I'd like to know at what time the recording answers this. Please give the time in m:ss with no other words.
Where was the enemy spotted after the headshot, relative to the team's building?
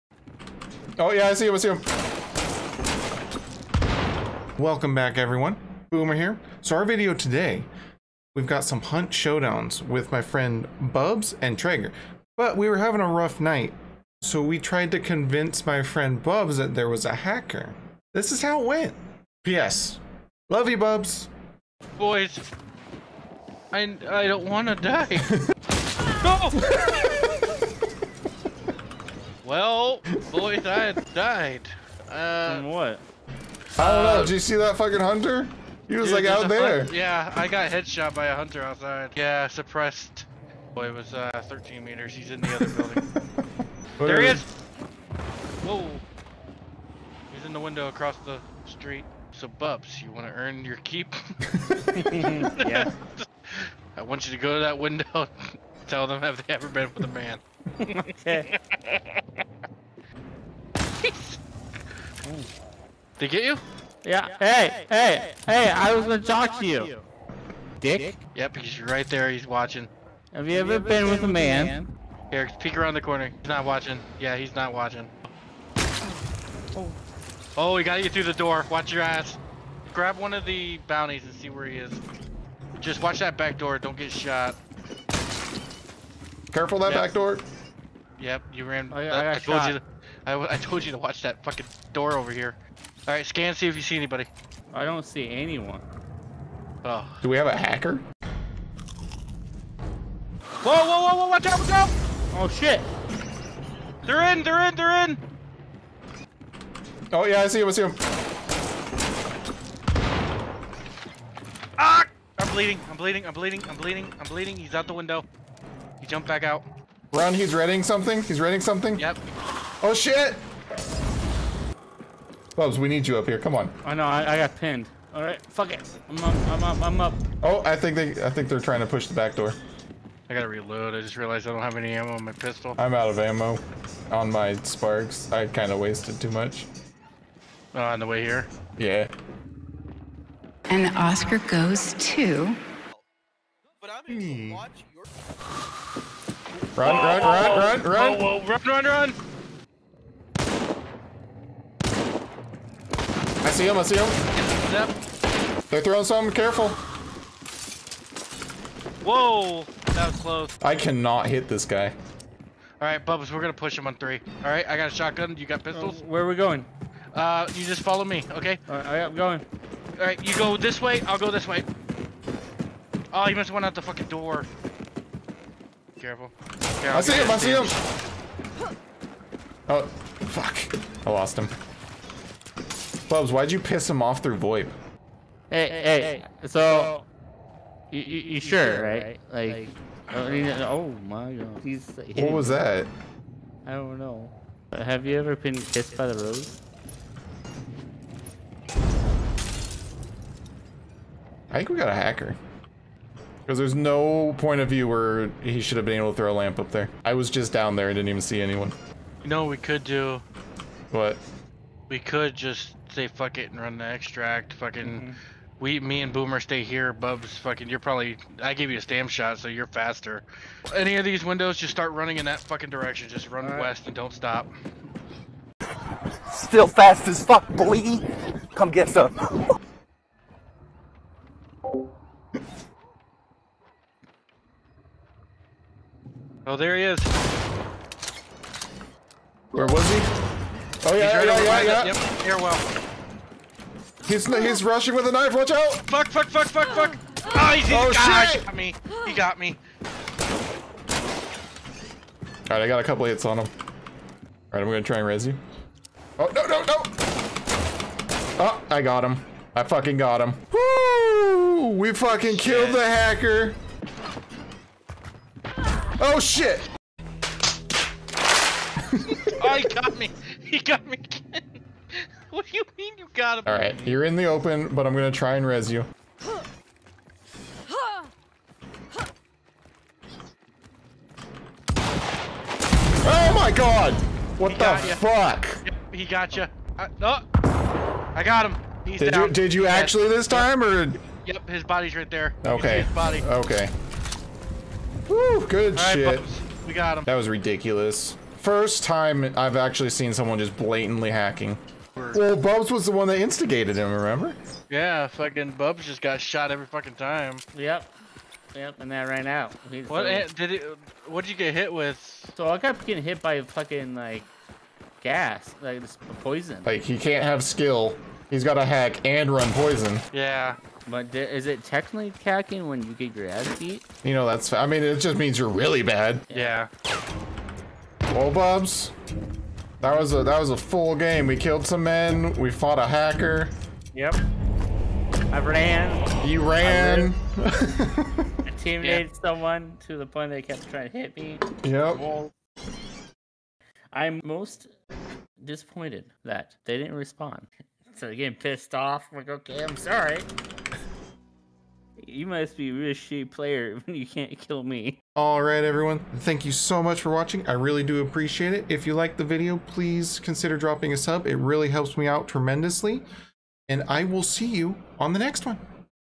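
0:47.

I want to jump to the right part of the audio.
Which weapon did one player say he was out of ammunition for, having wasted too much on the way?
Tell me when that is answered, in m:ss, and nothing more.
2:14.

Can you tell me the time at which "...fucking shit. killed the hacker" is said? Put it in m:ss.
4:21.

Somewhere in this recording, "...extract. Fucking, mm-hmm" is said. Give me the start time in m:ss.
3:33.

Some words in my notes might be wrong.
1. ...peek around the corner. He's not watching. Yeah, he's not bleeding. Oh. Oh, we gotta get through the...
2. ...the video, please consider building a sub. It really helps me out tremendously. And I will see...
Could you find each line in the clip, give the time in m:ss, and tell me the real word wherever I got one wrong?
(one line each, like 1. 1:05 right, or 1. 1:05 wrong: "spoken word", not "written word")
1. 1:12 wrong: "watching", not "bleeding"
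2. 5:59 wrong: "dropping", not "building".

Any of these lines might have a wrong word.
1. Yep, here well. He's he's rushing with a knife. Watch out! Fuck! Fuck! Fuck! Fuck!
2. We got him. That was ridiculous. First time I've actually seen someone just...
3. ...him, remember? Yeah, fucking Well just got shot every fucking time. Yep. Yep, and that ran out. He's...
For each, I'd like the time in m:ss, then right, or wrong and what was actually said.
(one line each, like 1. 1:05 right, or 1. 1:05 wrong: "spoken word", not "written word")
1. 4:01 right
2. 4:56 right
3. 5:03 wrong: "Bubz", not "Well".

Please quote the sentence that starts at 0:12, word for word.
But we were having a rough night, so we tried to convince my friend Bubz that there was a hacker.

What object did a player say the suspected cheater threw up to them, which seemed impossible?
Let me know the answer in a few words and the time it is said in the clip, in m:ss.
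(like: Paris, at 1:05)
A lamp, at 3:26.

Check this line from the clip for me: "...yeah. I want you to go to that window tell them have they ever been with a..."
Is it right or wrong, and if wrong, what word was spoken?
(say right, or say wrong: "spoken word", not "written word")
right.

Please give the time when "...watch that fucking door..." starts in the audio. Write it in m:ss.
1:30.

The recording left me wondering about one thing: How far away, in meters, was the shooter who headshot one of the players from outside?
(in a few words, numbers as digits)
13 meters.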